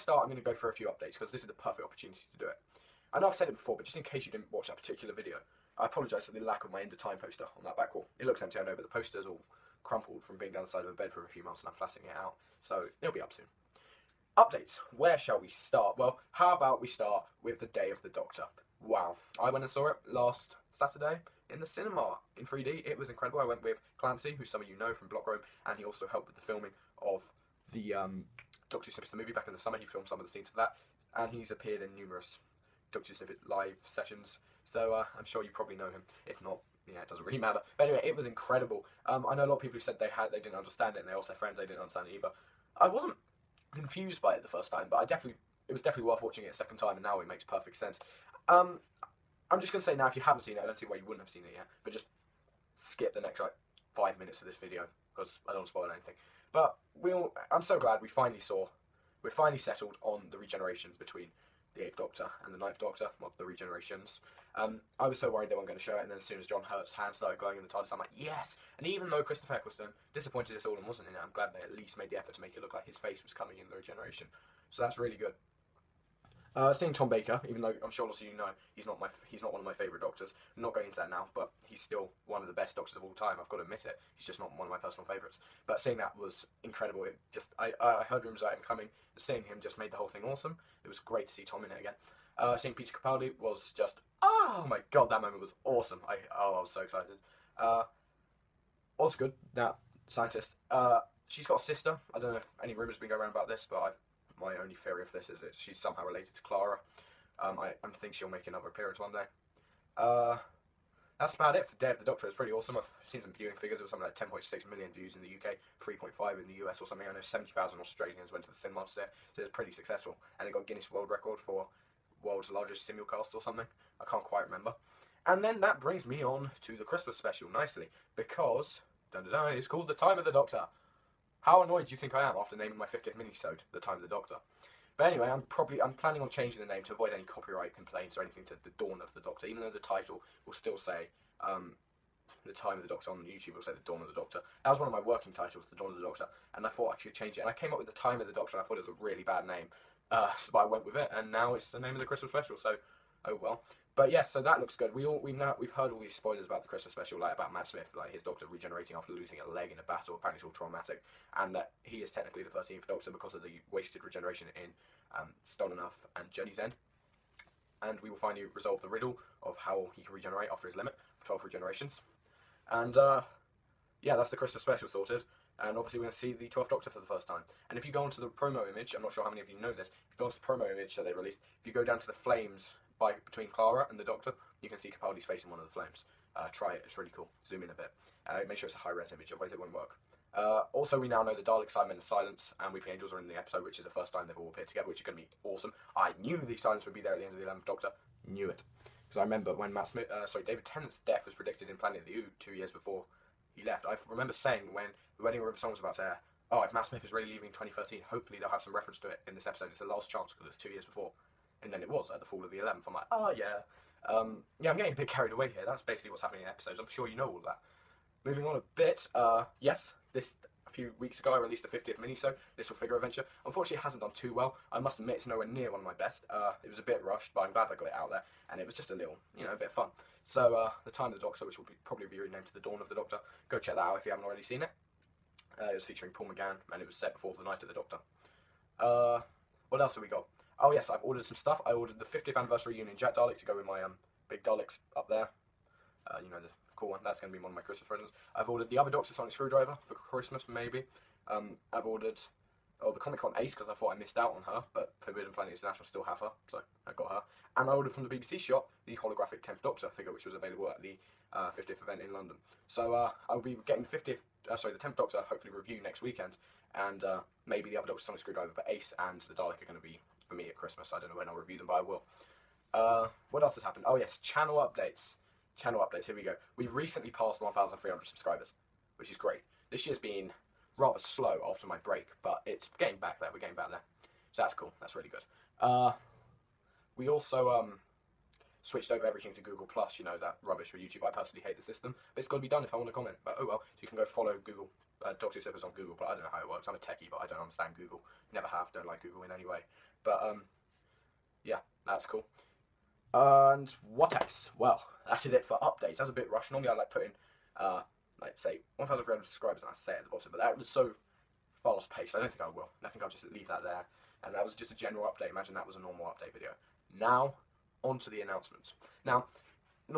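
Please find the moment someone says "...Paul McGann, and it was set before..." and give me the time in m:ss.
3:56.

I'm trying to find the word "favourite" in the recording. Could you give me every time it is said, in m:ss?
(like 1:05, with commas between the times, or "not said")
1:19, 1:25.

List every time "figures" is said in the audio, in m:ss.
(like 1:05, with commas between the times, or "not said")
1:53, 3:42, 4:19.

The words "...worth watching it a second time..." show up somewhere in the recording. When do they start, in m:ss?
0:46.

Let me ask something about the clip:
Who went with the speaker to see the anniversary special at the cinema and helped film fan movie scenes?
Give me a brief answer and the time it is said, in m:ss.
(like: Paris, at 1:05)
Clancy, at 0:23.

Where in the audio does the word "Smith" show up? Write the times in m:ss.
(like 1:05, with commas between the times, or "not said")
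2:37, 3:19, 3:26.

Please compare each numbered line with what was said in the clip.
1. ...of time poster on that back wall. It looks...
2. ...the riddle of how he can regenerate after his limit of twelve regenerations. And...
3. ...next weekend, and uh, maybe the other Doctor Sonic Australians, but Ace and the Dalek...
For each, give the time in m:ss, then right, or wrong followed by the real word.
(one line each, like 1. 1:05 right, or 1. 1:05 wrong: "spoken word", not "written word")
1. 0:06 right
2. 2:48 right
3. 4:25 wrong: "Screwdriver", not "Australians".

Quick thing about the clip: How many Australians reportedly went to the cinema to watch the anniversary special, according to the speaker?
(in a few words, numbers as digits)
70,000.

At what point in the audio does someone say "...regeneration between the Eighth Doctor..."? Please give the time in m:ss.
1:00.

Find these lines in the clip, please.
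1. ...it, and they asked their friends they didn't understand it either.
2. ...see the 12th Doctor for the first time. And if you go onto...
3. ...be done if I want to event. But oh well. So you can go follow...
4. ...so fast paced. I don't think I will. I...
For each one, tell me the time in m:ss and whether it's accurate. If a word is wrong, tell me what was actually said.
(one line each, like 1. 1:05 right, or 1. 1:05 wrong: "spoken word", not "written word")
1. 0:40 right
2. 2:56 right
3. 4:52 wrong: "comment", not "event"
4. 5:10 right.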